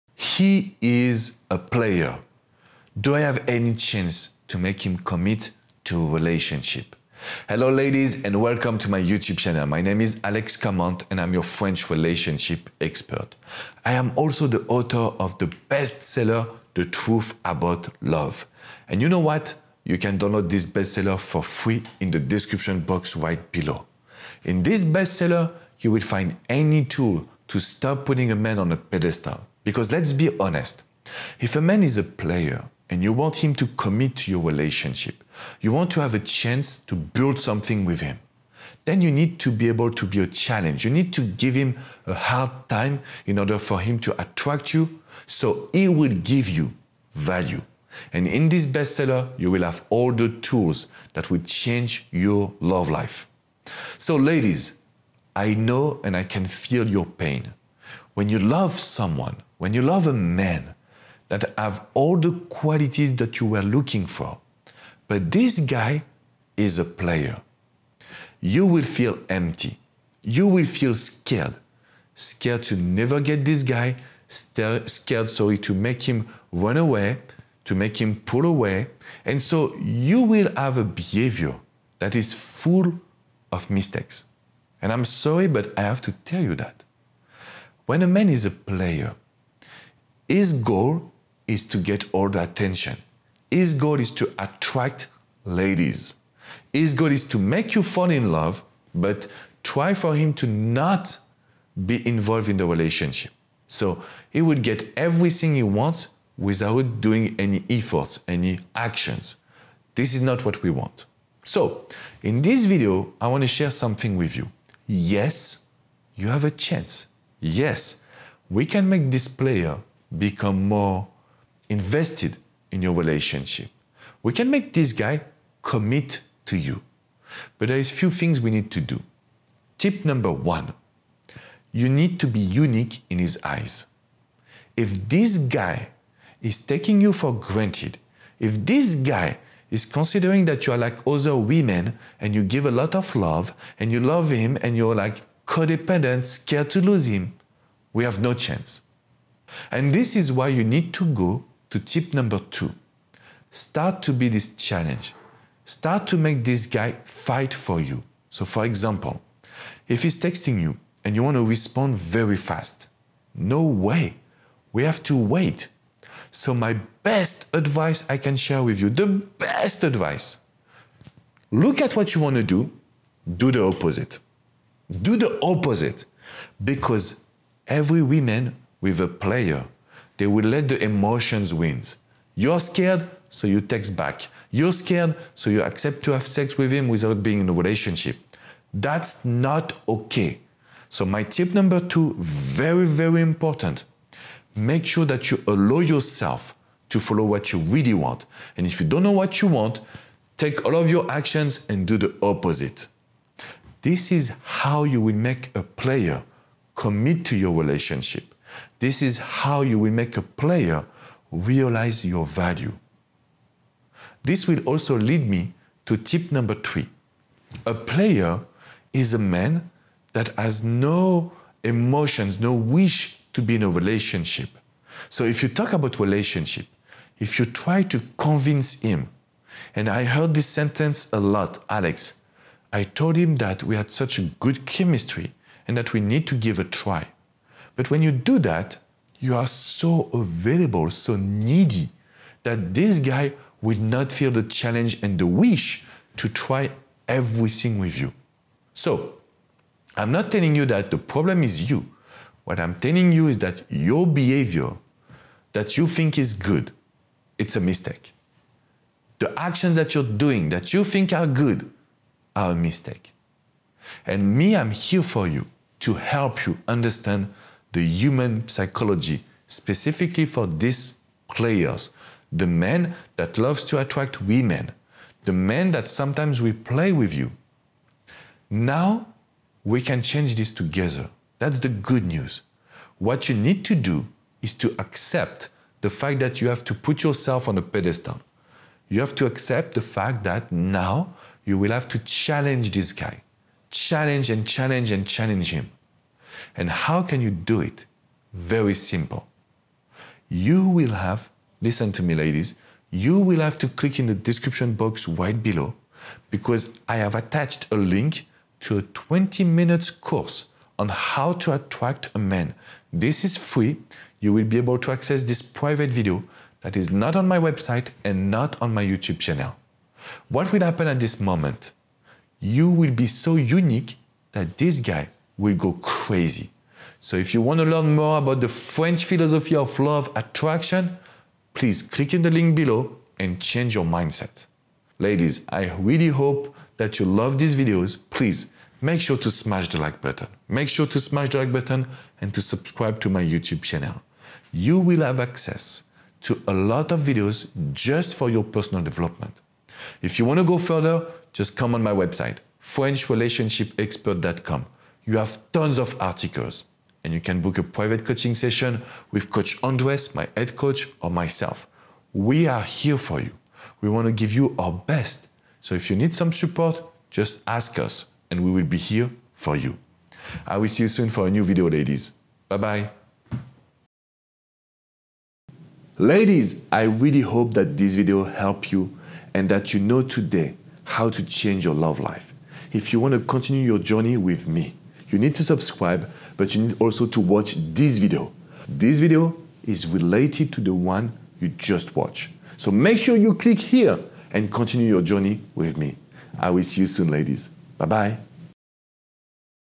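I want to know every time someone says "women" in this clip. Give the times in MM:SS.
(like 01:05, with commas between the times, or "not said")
02:21, 04:34.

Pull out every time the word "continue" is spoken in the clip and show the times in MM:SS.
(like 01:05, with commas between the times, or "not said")
06:23, 06:34.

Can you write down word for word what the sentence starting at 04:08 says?
So, I'm not telling you that the problem is you.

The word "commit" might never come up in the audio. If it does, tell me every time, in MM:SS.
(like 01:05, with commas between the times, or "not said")
00:04, 00:33, 02:05, 03:26.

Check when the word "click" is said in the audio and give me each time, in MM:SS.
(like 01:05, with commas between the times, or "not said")
05:03, 05:31, 06:33.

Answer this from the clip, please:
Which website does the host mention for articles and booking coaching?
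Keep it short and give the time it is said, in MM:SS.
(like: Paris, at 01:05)
FrenchRelationshipExpert.com, at 05:52.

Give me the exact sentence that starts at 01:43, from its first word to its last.
So he would get everything he wants without doing any efforts, any actions.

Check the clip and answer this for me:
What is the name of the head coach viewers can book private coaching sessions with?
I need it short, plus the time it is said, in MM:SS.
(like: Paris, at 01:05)
Coach Andres, at 05:59.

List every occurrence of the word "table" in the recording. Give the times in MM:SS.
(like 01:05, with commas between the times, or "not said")
not said.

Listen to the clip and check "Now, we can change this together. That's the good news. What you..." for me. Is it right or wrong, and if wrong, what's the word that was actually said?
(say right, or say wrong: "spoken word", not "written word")
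right.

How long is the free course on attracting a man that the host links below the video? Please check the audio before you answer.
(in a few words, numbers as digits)
20 minutes.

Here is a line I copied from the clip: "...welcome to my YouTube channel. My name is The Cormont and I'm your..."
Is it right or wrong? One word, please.
wrong.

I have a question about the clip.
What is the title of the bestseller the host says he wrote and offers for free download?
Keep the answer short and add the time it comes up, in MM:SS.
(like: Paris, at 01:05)
The Truth About Love, at 00:16.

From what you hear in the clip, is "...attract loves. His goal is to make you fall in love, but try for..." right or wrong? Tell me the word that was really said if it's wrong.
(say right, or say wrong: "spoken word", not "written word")
wrong: "ladies", not "loves".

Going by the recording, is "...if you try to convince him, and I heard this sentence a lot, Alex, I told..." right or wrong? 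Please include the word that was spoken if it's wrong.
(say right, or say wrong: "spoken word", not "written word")
right.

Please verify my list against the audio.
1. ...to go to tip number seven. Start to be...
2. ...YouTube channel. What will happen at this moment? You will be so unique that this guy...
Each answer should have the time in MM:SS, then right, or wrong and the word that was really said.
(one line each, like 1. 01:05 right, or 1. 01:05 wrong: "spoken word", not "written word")
1. 02:30 wrong: "two", not "seven"
2. 05:18 right.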